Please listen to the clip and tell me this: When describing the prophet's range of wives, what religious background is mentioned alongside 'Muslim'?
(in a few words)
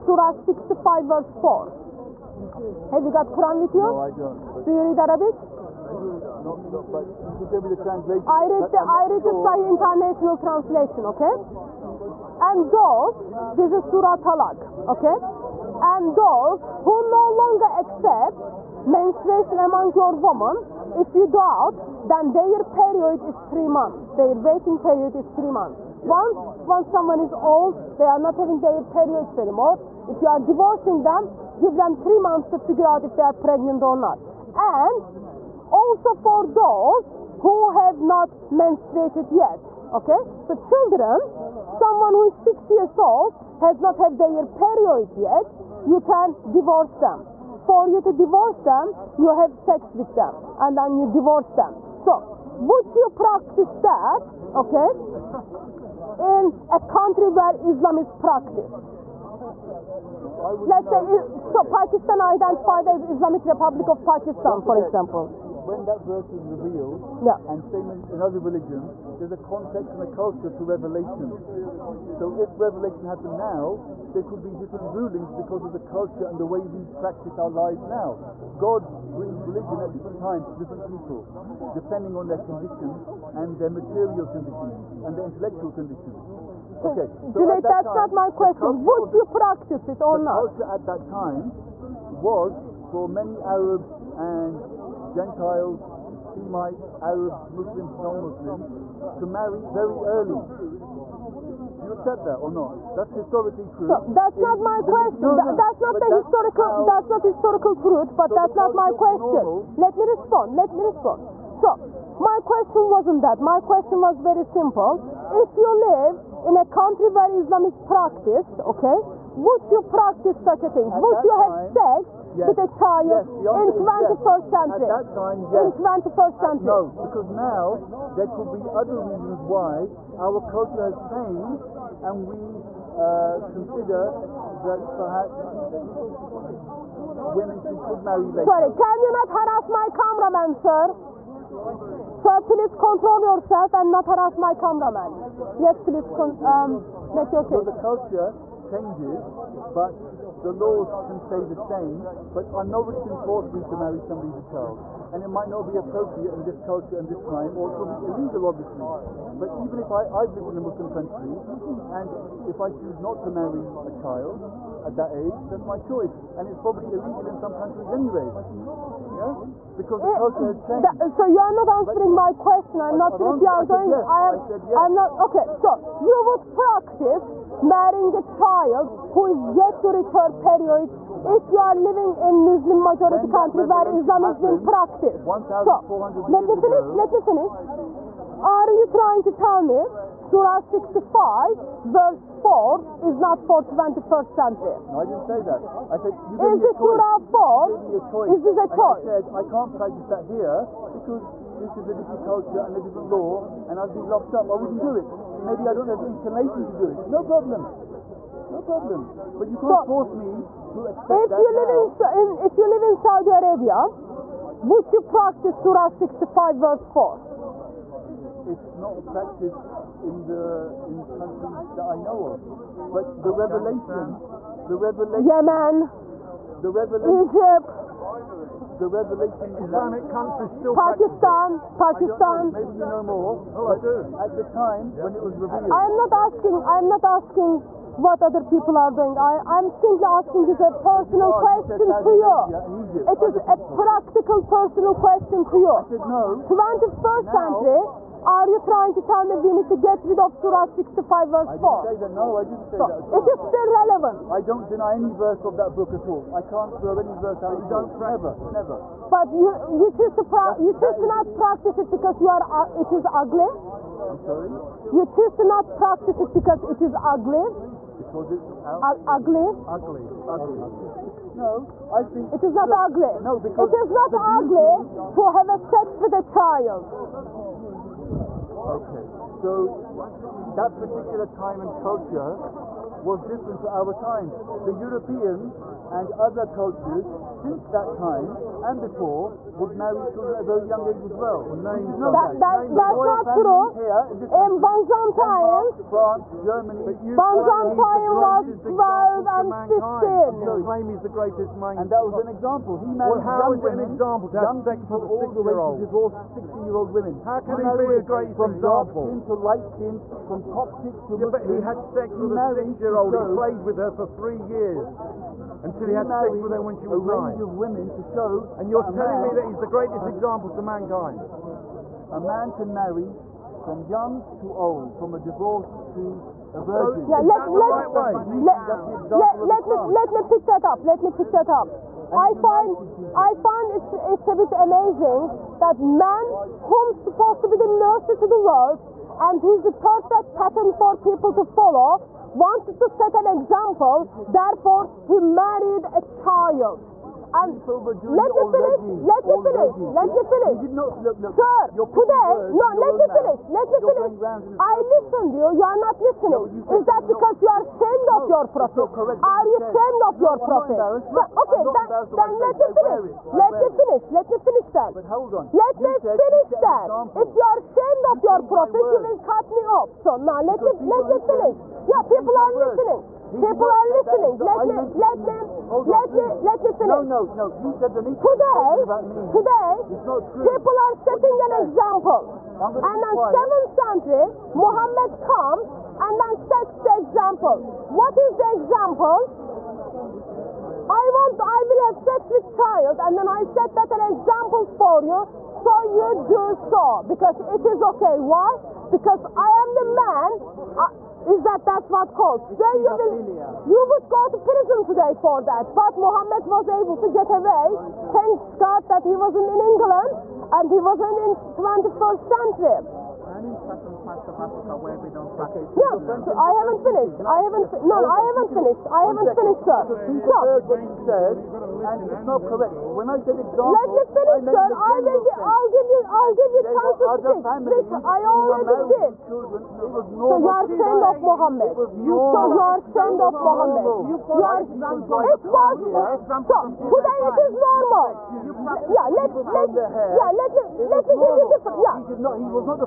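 Coptic.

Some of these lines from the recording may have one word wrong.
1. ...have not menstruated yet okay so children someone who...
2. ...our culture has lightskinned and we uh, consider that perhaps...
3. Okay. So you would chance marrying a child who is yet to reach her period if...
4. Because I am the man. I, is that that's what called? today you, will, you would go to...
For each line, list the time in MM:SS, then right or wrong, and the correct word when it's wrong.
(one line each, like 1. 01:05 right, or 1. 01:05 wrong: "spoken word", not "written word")
1. 00:37 right
2. 02:10 wrong: "changed", not "lightskinned"
3. 02:55 wrong: "practice", not "chance"
4. 06:38 right.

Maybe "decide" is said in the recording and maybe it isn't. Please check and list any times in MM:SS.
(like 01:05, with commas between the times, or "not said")
not said.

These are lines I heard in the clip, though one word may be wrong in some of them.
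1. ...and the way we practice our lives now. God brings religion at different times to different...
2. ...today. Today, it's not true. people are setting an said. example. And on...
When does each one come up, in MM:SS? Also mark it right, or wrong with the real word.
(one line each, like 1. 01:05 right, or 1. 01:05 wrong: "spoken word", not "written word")
1. 01:16 right
2. 06:18 right.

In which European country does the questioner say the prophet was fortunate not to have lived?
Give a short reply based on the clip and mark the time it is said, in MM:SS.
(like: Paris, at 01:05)
England, at 06:49.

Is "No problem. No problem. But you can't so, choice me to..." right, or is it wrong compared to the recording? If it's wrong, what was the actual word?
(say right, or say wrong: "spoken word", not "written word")
wrong: "force", not "choice".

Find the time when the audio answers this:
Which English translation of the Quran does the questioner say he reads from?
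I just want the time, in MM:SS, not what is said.
00:09.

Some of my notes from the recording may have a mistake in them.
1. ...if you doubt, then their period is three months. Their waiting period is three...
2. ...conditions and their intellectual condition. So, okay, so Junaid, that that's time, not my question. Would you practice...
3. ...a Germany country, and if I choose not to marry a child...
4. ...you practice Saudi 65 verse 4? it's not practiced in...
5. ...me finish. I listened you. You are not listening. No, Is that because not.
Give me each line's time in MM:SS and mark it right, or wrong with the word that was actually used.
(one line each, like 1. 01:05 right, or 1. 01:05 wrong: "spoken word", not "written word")
1. 00:20 right
2. 01:24 right
3. 02:40 wrong: "Muslim", not "Germany"
4. 03:34 wrong: "Surah", not "Saudi"
5. 05:53 right.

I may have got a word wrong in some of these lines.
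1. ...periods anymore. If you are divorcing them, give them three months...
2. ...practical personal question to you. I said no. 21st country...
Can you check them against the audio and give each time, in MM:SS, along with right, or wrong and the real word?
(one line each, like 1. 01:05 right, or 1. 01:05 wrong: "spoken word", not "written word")
1. 00:28 right
2. 04:03 wrong: "century", not "country".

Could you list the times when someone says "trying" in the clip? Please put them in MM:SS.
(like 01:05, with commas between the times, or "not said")
03:08, 04:08.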